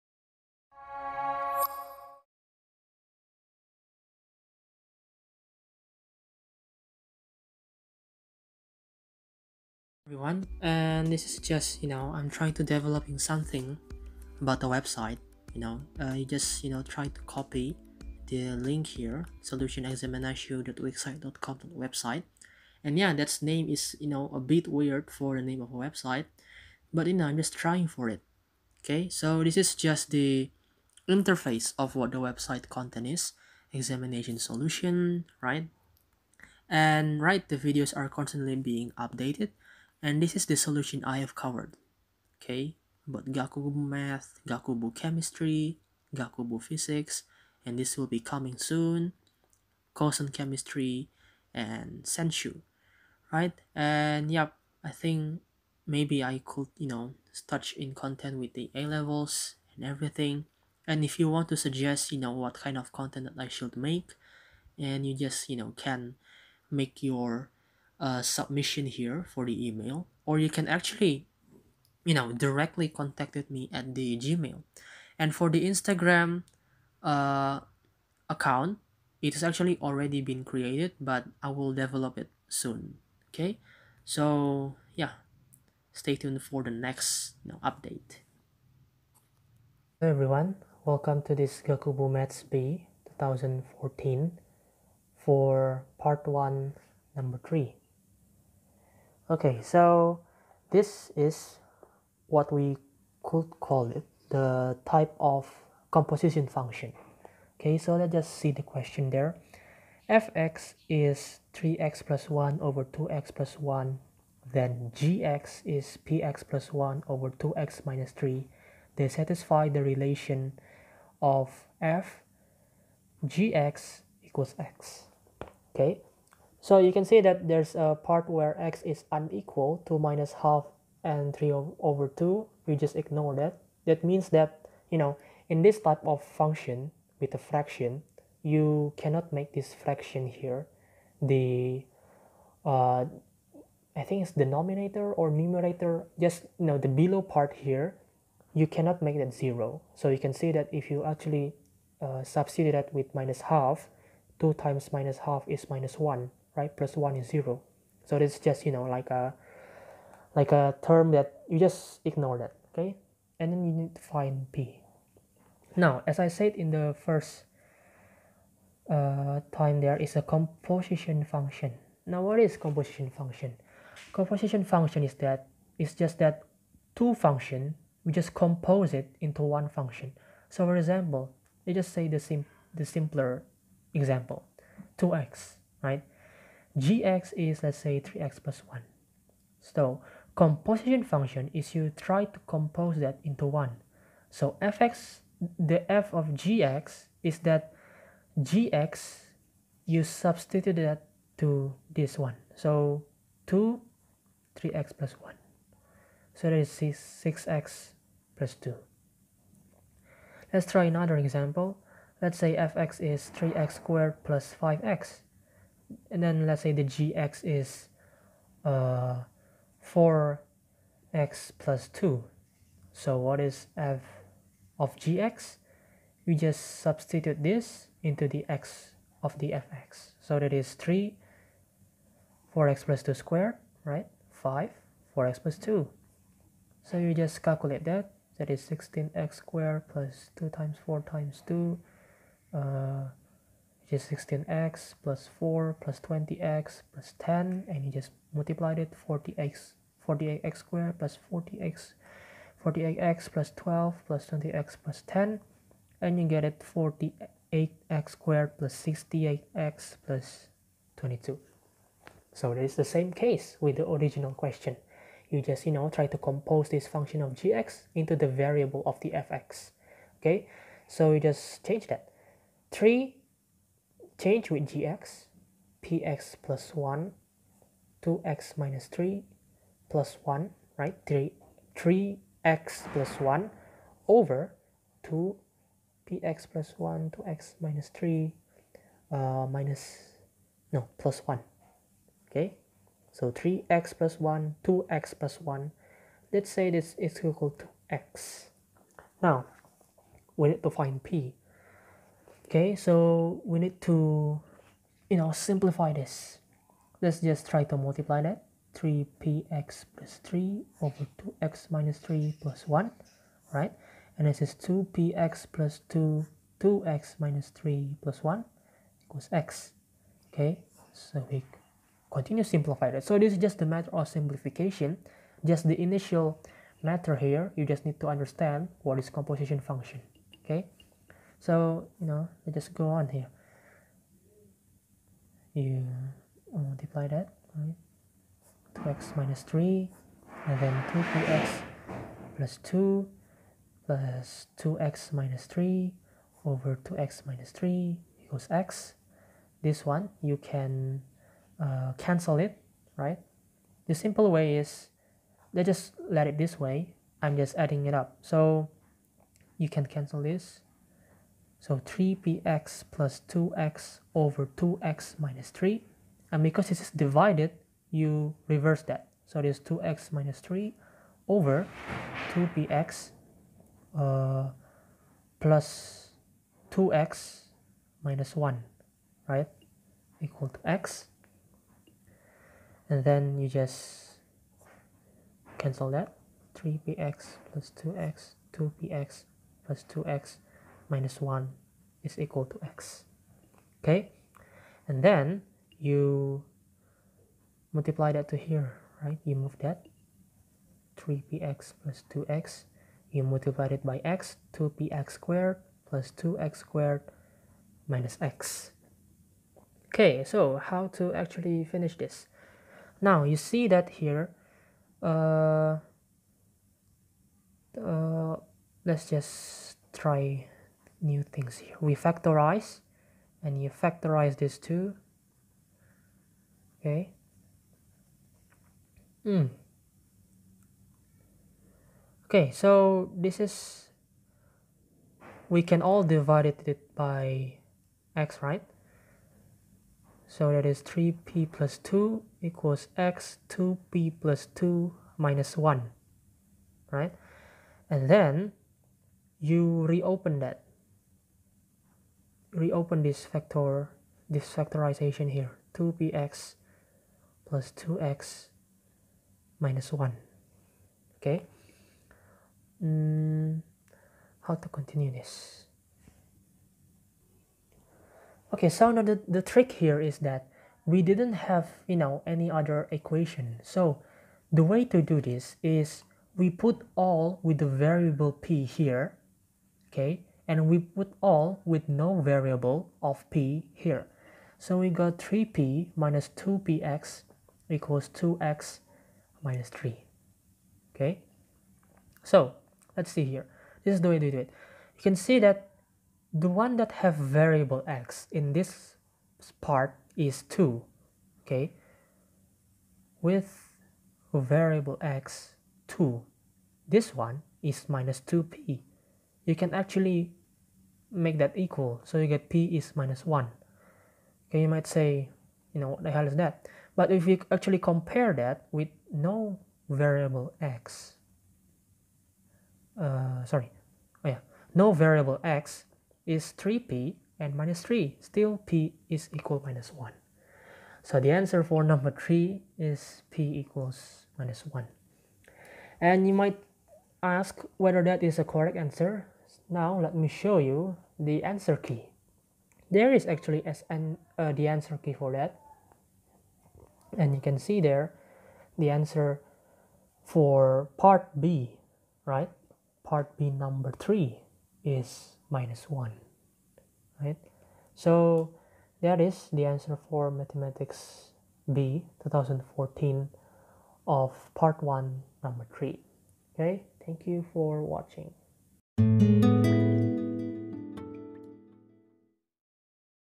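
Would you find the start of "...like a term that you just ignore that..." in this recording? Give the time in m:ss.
2:40.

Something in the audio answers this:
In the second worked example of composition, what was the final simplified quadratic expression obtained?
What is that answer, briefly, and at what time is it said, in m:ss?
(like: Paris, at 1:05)
48x² + 68x + 22, at 4:16.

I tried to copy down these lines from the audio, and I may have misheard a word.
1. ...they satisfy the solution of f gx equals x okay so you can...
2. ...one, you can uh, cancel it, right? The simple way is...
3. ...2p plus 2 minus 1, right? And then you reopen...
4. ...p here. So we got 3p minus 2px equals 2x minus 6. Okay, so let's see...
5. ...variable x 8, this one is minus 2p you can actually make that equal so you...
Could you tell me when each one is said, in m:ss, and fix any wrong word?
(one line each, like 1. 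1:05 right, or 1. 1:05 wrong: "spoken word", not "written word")
1. 1:58 wrong: "relation", not "solution"
2. 5:49 right
3. 7:23 right
4. 8:03 wrong: "3", not "6"
5. 8:24 wrong: "2", not "8".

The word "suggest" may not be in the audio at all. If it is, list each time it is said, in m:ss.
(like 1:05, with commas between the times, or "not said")
1:01.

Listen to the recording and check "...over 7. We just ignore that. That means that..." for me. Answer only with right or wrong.
wrong.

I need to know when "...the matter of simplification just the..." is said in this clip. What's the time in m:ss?
5:23.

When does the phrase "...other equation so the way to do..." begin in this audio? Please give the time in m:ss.
7:52.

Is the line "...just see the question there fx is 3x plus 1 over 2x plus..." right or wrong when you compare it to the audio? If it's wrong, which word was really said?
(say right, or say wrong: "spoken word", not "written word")
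right.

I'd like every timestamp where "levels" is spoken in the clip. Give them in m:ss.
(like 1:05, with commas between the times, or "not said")
0:58.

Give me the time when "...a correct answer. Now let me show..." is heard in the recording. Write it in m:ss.
8:58.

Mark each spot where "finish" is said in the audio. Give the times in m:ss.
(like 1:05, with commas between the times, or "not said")
6:51.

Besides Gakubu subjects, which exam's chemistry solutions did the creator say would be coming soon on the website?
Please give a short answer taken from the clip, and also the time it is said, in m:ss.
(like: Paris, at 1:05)
Kosen, at 0:49.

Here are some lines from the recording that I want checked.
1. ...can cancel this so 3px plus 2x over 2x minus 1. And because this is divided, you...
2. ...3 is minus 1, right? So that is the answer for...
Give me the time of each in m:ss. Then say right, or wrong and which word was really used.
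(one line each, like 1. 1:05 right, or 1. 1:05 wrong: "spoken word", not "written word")
1. 5:59 wrong: "3", not "1"
2. 9:13 right.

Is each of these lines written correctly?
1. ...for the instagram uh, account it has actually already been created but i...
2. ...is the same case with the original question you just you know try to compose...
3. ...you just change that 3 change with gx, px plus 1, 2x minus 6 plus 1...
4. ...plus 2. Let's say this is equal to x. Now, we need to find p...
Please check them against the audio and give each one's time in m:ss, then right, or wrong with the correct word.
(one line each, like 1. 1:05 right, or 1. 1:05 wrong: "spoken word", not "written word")
1. 1:15 right
2. 4:22 right
3. 4:31 wrong: "3", not "6"
4. 4:55 wrong: "1", not "2".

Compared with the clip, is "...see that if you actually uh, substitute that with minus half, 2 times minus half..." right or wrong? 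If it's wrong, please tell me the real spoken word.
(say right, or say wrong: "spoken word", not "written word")
right.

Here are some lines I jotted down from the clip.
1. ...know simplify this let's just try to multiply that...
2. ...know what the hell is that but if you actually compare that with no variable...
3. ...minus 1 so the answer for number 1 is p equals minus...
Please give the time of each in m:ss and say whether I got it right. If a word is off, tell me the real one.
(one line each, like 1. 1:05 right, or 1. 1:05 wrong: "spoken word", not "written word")
1. 5:05 right
2. 8:35 right
3. 8:49 wrong: "3", not "1".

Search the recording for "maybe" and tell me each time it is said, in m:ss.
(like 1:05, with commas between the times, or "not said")
0:55.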